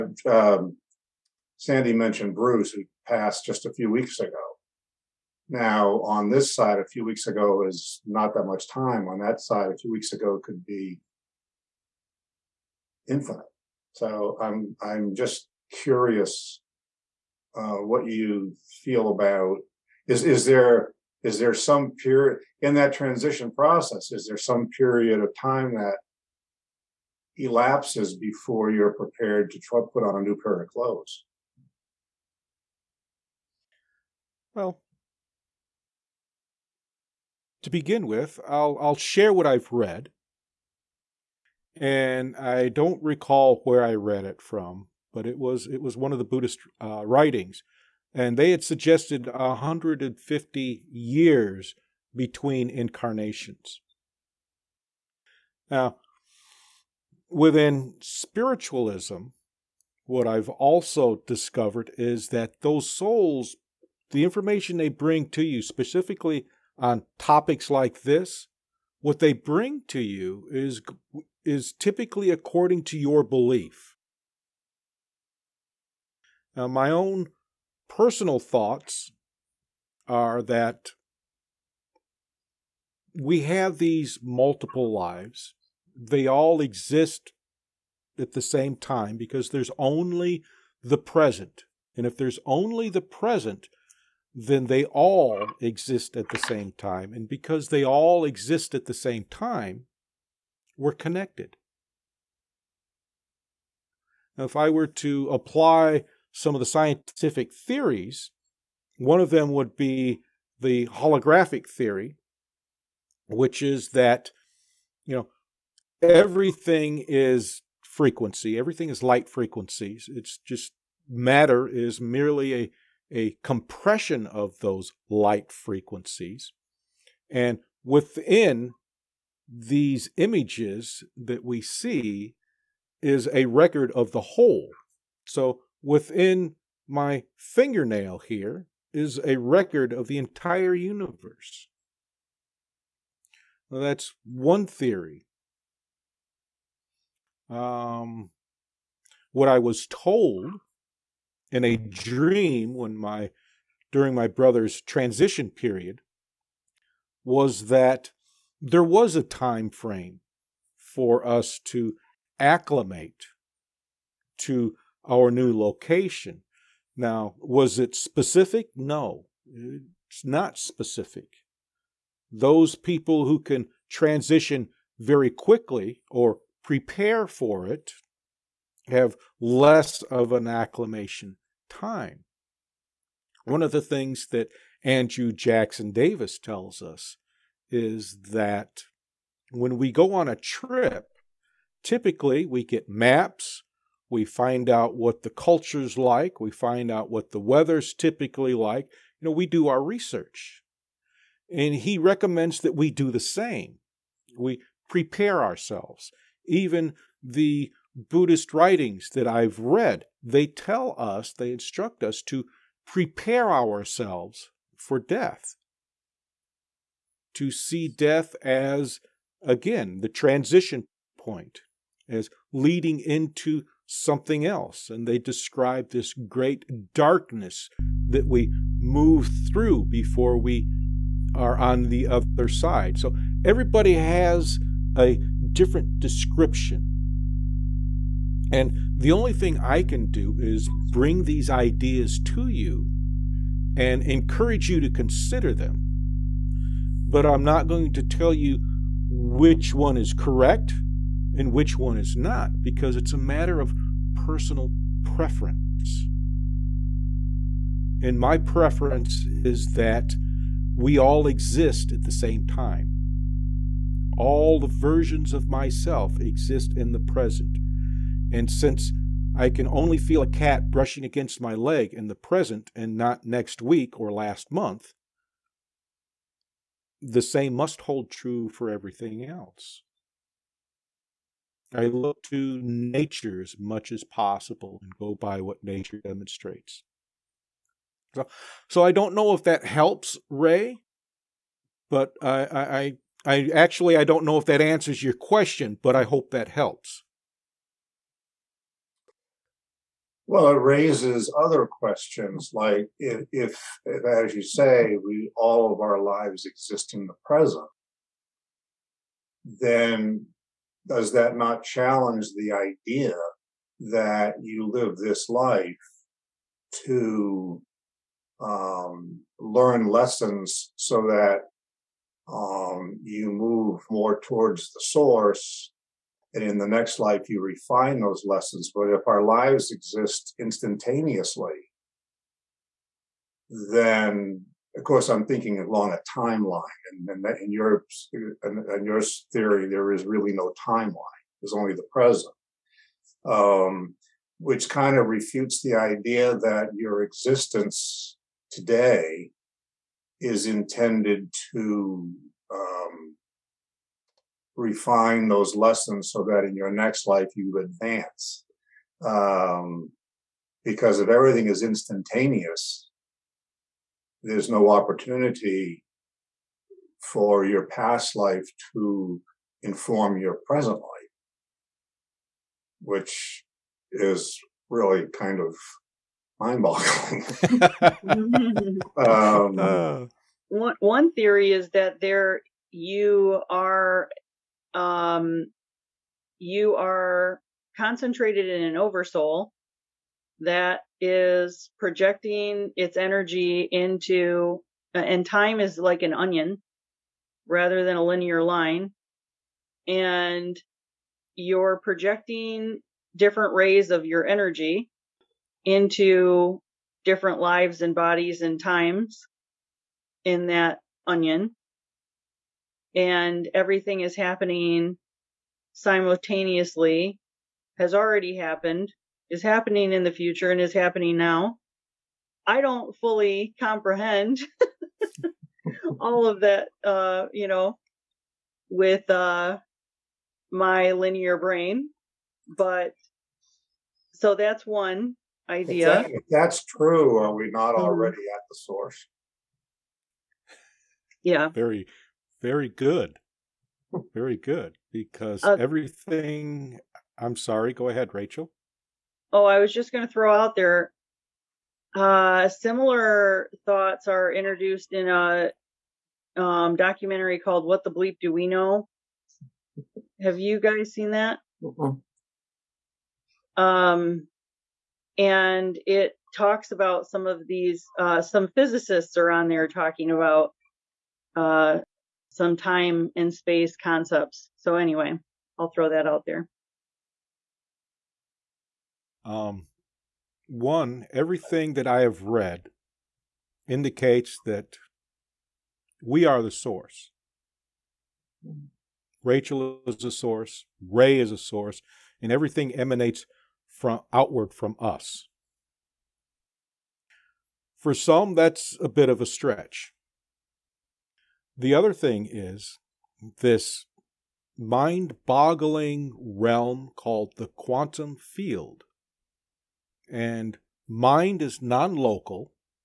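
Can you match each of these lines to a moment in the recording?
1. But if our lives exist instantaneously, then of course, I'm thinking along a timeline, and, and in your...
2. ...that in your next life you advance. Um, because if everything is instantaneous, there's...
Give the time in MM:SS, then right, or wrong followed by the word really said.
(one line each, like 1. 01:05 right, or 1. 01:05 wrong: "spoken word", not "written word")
1. 05:28 right
2. 05:56 right.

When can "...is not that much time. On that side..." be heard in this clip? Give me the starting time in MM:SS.
00:07.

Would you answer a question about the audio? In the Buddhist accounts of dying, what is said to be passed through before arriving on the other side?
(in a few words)
great darkness.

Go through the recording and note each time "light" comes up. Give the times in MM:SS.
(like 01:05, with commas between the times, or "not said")
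01:59, 02:05.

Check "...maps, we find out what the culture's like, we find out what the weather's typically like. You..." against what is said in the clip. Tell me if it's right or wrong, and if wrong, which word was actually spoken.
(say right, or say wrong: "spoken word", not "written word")
right.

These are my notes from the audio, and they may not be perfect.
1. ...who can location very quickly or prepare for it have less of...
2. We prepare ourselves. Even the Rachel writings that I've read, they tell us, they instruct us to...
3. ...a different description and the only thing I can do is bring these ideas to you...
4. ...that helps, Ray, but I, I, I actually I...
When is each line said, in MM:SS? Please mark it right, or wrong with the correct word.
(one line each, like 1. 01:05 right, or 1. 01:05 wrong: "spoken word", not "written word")
1. 02:53 wrong: "transition", not "location"
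2. 03:24 wrong: "Buddhist", not "Rachel"
3. 03:54 right
4. 04:49 right.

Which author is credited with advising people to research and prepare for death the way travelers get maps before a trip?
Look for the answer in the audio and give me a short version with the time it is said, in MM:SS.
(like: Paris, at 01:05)
Andrew Jackson Davis, at 03:04.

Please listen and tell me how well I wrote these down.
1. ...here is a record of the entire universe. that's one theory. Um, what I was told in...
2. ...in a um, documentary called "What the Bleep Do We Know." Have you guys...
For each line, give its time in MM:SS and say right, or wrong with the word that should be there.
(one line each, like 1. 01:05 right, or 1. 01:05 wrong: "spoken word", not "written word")
1. 02:18 right
2. 07:34 right.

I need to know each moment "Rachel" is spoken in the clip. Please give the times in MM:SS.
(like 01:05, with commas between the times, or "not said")
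07:28, 08:09.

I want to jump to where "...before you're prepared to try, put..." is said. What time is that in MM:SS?
00:28.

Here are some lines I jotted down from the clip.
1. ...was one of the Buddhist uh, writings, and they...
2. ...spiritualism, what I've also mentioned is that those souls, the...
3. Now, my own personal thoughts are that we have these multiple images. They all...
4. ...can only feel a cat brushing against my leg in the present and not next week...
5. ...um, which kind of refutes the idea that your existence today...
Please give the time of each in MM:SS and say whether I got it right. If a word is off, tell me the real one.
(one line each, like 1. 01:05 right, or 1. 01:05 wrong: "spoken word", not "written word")
1. 00:45 right
2. 00:58 wrong: "discovered", not "mentioned"
3. 01:16 wrong: "lives", not "images"
4. 04:29 right
5. 05:43 right.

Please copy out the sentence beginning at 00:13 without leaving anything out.
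So I'm I'm just curious uh, what you feel about is is there is there some period in that transition process?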